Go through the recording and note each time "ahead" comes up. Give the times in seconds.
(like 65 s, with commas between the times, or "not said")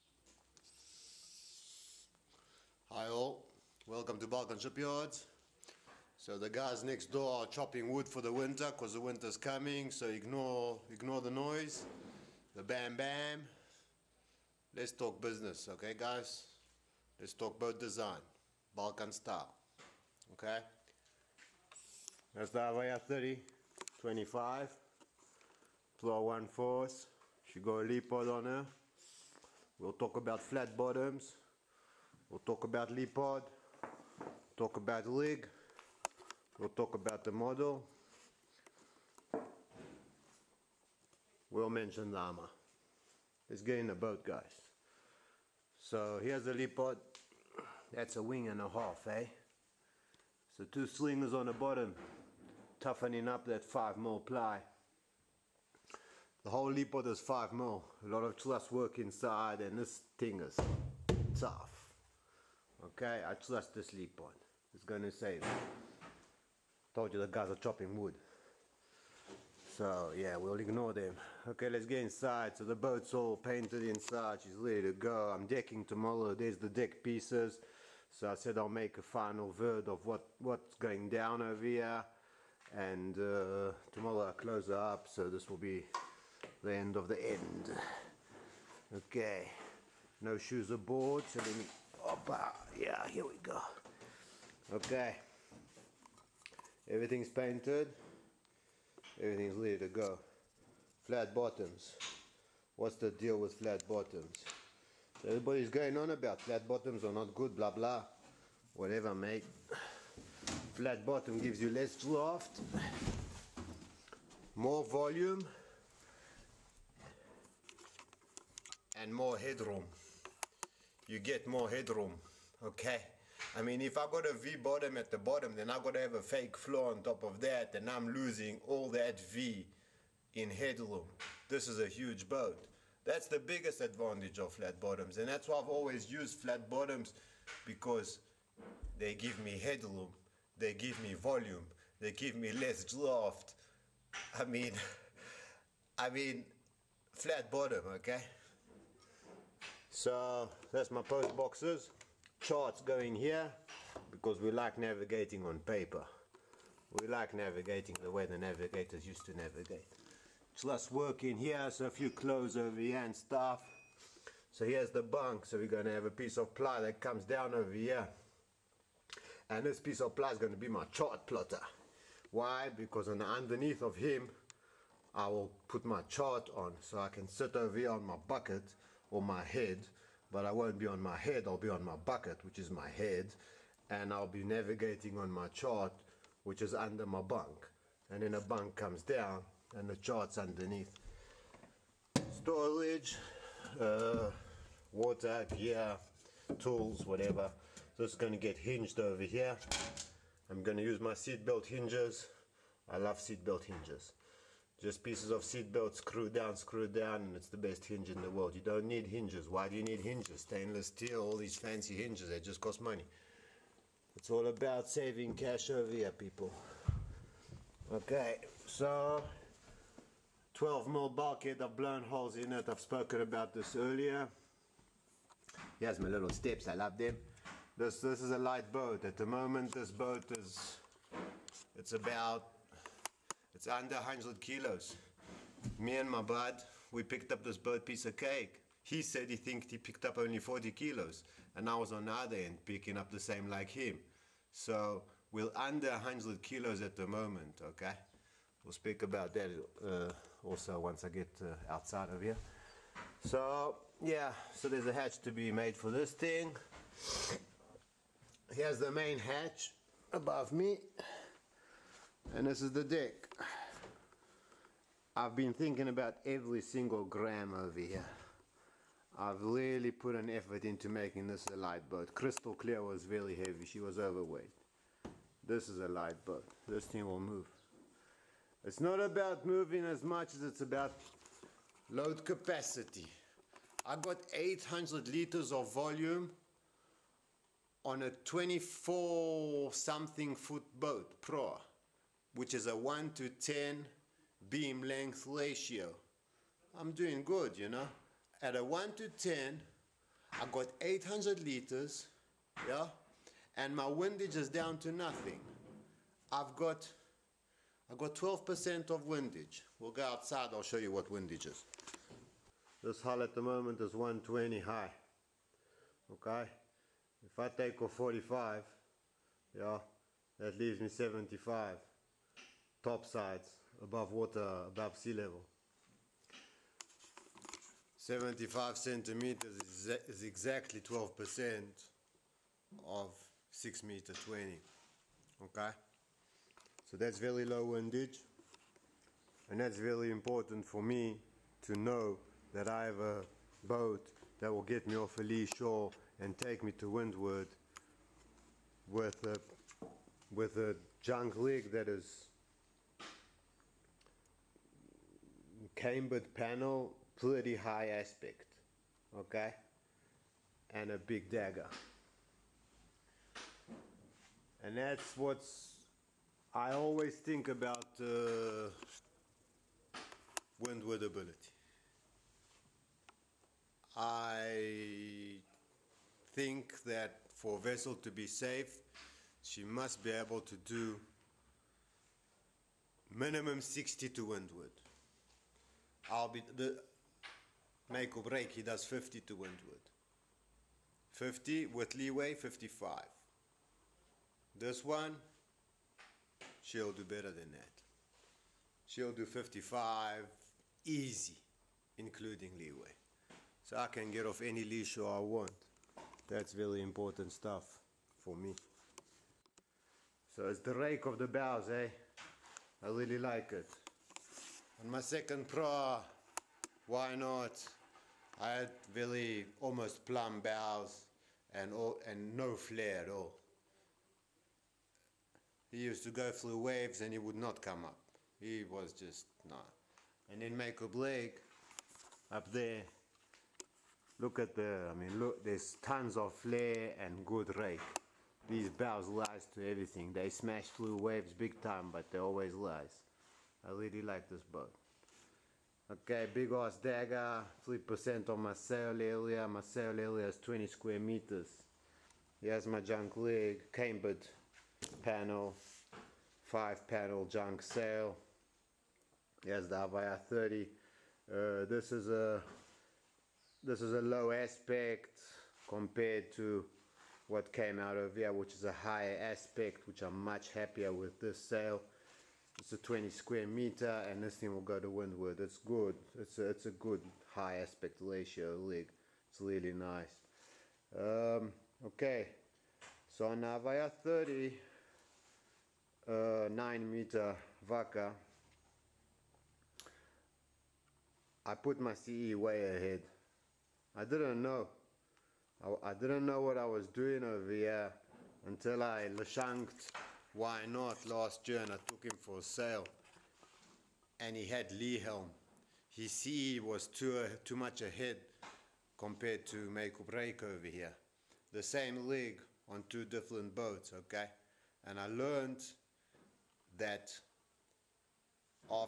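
492 s, 507 s.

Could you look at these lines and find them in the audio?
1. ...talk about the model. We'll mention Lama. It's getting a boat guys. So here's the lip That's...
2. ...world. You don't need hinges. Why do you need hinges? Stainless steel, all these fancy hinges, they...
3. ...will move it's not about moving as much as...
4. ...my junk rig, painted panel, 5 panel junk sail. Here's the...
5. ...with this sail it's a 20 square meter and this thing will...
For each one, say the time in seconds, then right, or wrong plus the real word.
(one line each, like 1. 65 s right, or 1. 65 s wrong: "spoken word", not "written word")
1. 36 s right
2. 208 s right
3. 277 s right
4. 452 s wrong: "cambered", not "painted"
5. 470 s right.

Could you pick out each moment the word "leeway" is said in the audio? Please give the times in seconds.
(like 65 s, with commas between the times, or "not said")
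391 s, 402 s.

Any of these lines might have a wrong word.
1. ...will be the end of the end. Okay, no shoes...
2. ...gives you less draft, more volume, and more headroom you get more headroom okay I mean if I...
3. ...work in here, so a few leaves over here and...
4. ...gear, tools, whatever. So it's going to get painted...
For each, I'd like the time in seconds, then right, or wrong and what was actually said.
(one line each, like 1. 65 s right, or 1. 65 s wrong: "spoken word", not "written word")
1. 85 s right
2. 111 s right
3. 160 s wrong: "clothes", not "leaves"
4. 195 s wrong: "hinged", not "painted".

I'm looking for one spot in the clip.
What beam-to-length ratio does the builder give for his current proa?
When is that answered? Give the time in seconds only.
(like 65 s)
292 s.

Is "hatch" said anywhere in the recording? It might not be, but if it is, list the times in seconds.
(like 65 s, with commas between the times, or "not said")
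254 s, 259 s.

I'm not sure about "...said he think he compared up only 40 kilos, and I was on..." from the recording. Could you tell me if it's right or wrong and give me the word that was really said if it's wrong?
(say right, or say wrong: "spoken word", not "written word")
wrong: "picked", not "compared".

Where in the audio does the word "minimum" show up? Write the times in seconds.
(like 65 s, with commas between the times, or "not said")
383 s.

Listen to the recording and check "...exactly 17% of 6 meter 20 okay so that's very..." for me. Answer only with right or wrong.
wrong.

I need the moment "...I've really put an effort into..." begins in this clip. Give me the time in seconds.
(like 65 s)
269 s.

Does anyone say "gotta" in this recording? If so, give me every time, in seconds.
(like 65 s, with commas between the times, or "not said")
125 s.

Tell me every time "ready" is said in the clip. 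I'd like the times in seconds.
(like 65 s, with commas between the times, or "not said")
74 s, 99 s.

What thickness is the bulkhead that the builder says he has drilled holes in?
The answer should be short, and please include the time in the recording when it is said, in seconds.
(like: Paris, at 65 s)
12 mil, at 220 s.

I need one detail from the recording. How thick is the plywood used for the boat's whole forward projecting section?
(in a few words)
5 mil.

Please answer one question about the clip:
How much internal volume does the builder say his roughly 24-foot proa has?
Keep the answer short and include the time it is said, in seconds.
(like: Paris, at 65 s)
800 liters, at 284 s.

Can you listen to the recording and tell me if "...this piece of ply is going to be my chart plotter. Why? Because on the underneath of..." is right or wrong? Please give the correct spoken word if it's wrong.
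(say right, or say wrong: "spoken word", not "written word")
right.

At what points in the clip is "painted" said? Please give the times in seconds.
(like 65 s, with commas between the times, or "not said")
73 s, 97 s.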